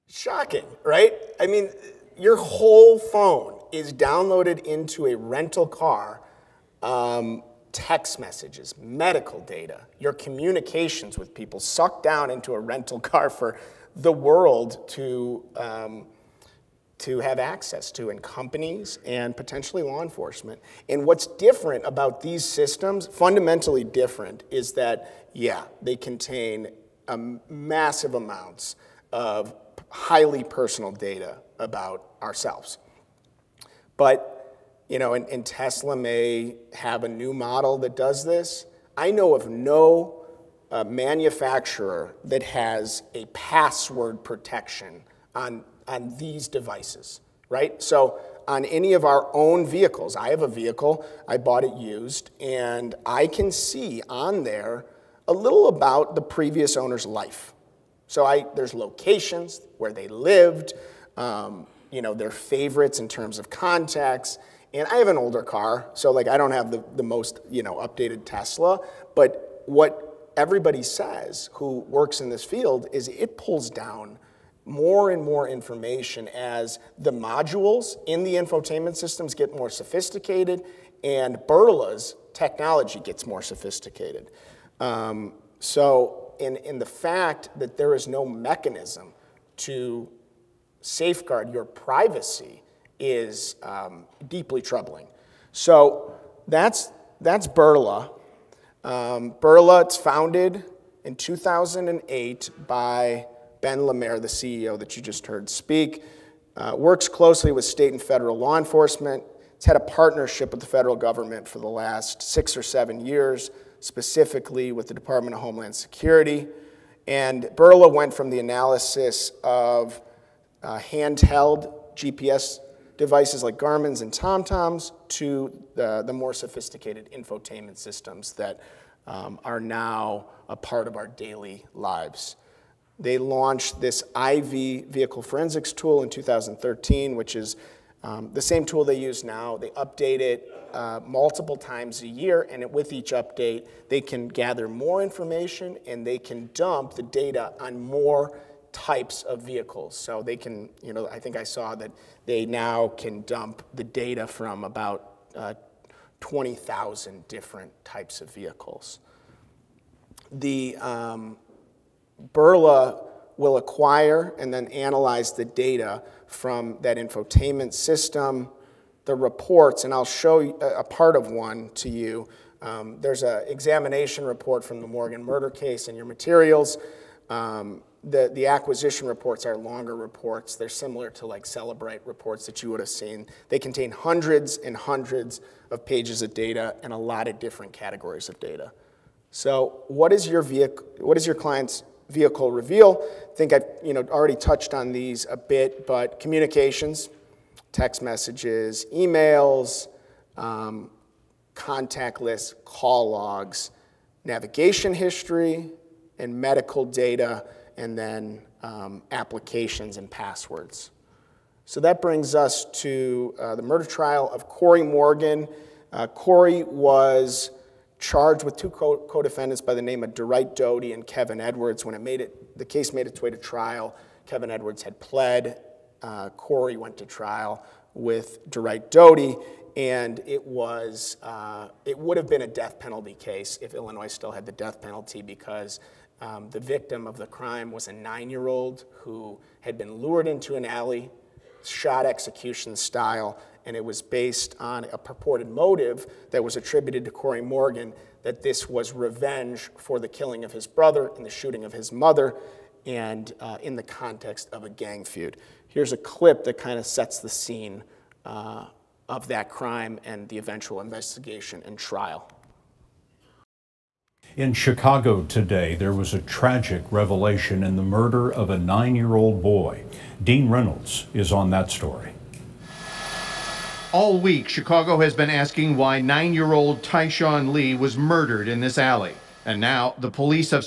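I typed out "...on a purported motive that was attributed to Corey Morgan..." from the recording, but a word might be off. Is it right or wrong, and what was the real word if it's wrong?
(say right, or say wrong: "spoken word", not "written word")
right.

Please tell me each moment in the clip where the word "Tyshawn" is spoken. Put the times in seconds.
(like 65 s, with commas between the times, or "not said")
276 s.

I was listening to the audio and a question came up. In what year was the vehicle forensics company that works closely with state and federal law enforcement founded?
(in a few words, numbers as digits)
2008.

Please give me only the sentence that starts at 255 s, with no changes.
Here's a clip that kind of sets the scene uh, of that crime and the eventual investigation and trial.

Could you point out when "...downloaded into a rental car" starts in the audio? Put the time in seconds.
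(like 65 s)
3 s.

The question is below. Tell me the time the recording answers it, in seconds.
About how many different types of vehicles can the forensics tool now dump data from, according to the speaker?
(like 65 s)
156 s.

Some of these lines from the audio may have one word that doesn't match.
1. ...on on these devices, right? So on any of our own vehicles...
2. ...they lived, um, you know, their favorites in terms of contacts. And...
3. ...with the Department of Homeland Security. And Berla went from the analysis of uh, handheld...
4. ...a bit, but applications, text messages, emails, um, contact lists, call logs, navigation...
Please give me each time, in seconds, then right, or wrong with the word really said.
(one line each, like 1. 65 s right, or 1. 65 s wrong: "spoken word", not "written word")
1. 45 s right
2. 59 s right
3. 114 s right
4. 195 s wrong: "communications", not "applications".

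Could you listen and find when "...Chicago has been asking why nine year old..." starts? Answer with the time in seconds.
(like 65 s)
274 s.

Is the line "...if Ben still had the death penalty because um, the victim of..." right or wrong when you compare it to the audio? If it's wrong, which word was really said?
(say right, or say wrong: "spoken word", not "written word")
wrong: "Illinois", not "Ben".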